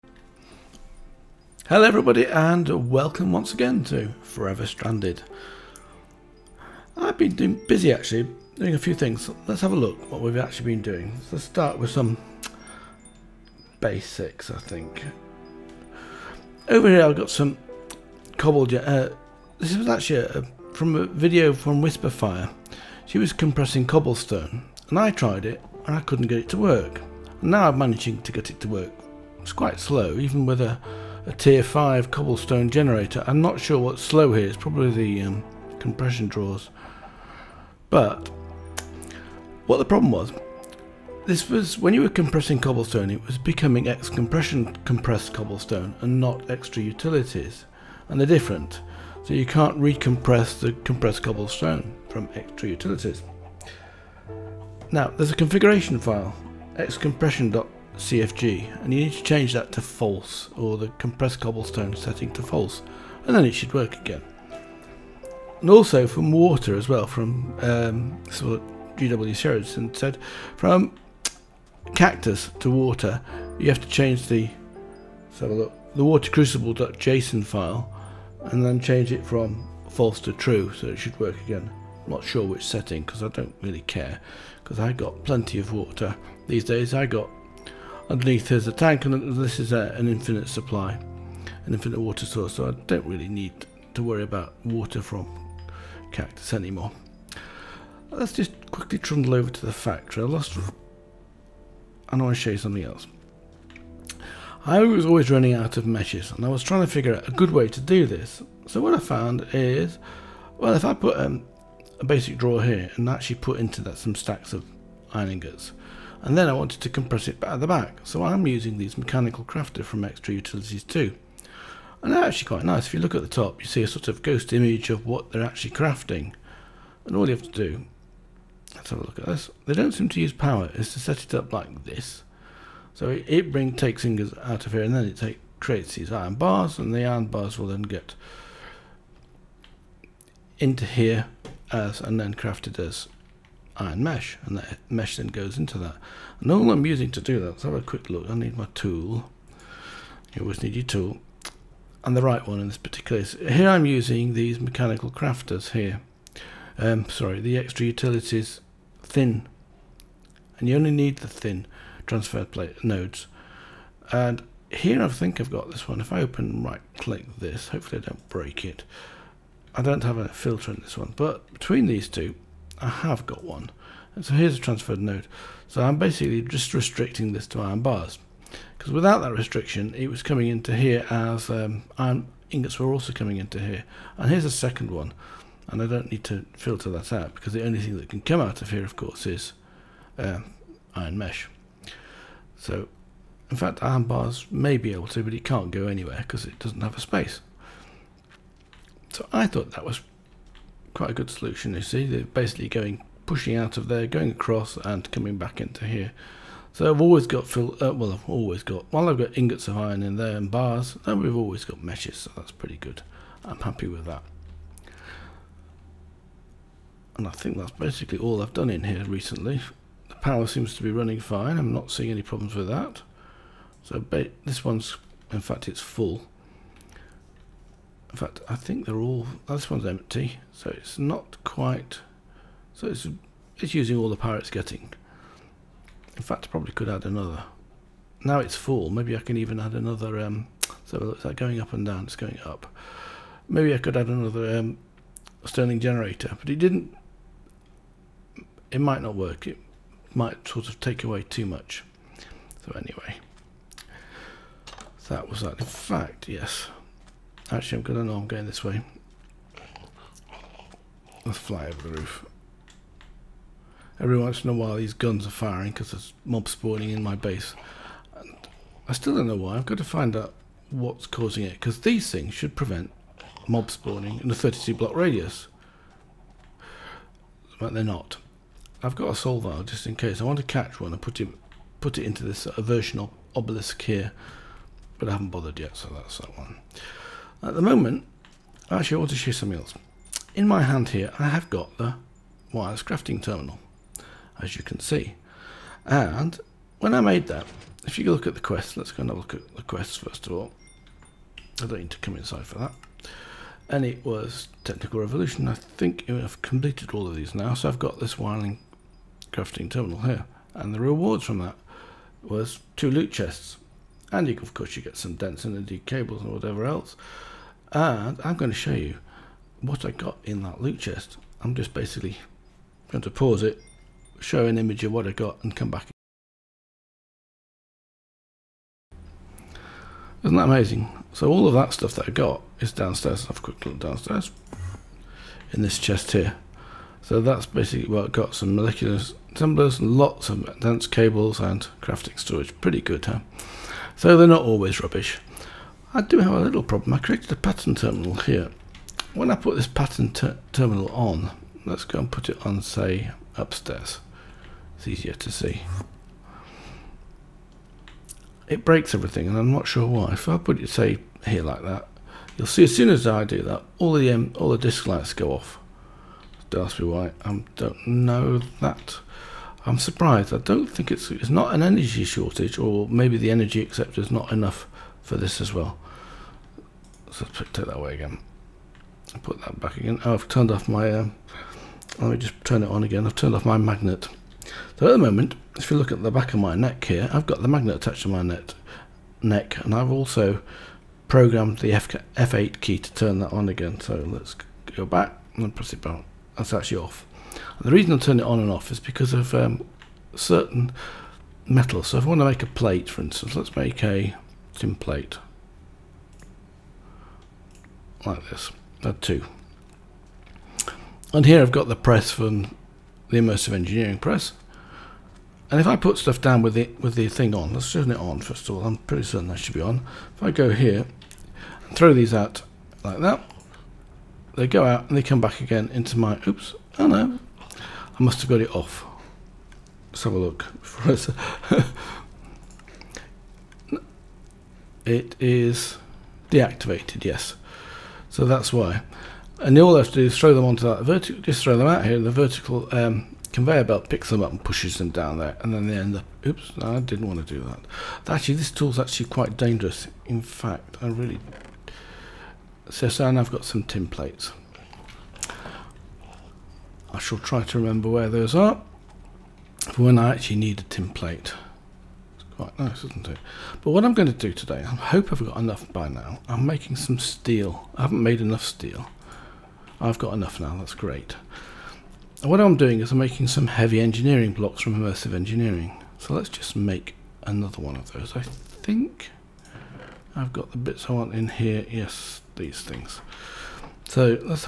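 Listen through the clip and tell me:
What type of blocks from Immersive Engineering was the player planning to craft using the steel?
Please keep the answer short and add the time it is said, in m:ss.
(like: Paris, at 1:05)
heavy engineering blocks, at 7:53.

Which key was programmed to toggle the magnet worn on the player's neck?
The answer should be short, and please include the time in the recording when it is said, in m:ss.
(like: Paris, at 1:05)
F8, at 6:31.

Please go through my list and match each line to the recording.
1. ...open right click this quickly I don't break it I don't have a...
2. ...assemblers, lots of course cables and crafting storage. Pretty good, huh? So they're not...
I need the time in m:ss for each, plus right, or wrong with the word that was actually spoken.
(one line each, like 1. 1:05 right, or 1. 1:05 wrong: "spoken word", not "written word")
1. 2:46 wrong: "hopefully", not "quickly"
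2. 5:39 wrong: "dense", not "course".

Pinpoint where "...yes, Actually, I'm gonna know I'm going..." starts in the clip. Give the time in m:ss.
4:16.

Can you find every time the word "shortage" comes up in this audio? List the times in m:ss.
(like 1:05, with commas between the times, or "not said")
6:12.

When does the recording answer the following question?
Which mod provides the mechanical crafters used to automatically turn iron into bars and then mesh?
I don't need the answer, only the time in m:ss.
2:00.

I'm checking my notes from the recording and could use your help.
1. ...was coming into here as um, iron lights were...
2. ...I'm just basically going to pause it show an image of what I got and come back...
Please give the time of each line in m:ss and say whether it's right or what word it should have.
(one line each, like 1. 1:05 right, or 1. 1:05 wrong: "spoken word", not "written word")
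1. 3:00 wrong: "ingots", not "lights"
2. 5:21 right.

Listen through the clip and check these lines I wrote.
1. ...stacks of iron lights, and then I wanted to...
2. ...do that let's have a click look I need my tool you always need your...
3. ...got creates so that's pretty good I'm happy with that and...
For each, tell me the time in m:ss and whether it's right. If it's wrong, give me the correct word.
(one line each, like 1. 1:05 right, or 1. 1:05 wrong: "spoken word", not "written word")
1. 1:54 wrong: "ingots", not "lights"
2. 2:27 wrong: "quick", not "click"
3. 3:31 wrong: "meshes", not "creates".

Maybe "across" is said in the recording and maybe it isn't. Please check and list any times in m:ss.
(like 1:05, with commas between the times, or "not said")
3:24.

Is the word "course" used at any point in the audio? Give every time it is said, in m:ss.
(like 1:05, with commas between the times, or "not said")
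3:08, 5:14.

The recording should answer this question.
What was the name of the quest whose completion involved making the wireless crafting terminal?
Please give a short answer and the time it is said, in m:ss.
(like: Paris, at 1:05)
Technical Revolution, at 5:04.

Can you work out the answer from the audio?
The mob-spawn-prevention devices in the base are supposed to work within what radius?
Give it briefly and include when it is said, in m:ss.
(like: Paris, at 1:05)
32 blocks, at 4:34.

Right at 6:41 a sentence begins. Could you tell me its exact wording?
So if I want to make a plate, for instance, let's make a tin plate like this.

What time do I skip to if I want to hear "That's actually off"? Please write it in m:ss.
6:36.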